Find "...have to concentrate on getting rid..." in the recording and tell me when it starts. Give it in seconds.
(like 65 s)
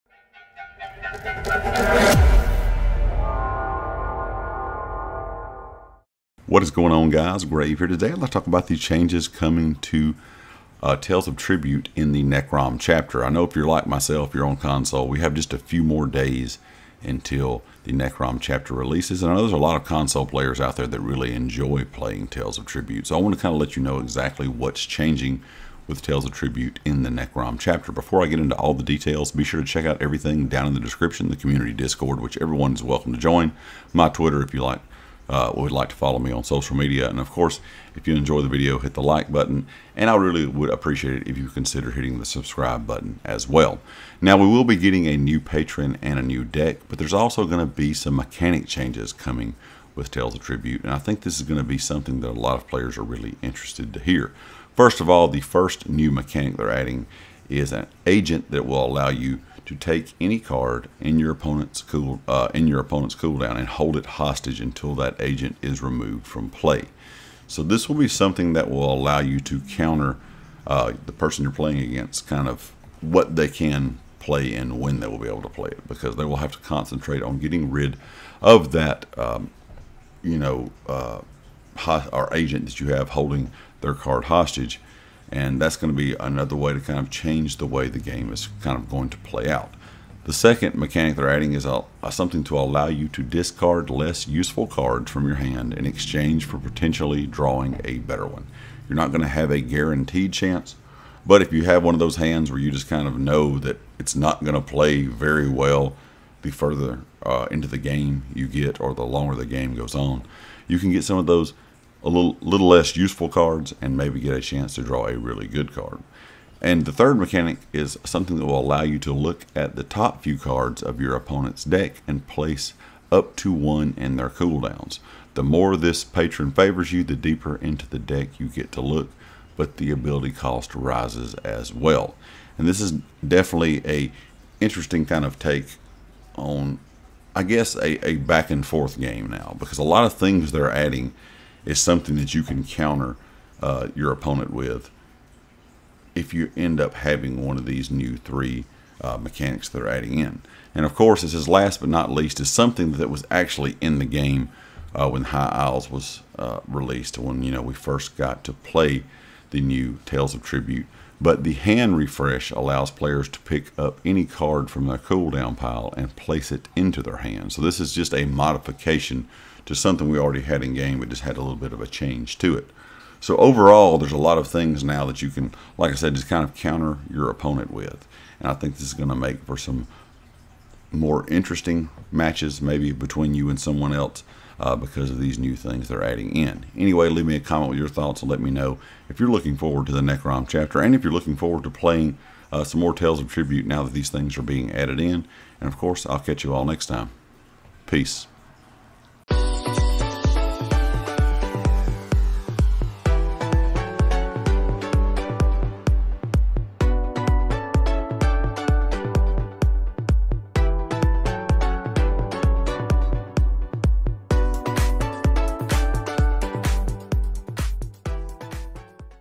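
76 s.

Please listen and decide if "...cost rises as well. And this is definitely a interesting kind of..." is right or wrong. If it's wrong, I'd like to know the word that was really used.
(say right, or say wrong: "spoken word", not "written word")
right.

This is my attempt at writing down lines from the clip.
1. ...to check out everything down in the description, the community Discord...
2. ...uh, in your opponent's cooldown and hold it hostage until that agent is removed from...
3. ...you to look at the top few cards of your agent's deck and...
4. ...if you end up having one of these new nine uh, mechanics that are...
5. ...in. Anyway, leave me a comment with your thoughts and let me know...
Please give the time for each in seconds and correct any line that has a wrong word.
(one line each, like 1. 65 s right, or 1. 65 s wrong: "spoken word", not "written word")
1. 29 s right
2. 62 s right
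3. 118 s wrong: "opponent", not "agent"
4. 146 s wrong: "three", not "nine"
5. 186 s right.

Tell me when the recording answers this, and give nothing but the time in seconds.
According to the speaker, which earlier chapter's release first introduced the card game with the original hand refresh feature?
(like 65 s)
155 s.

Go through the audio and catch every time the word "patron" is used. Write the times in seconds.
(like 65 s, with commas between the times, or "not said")
45 s, 126 s.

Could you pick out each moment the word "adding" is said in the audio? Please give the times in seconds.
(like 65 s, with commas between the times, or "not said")
56 s, 91 s, 140 s, 149 s, 186 s.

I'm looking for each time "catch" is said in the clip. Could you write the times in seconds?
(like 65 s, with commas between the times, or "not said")
196 s.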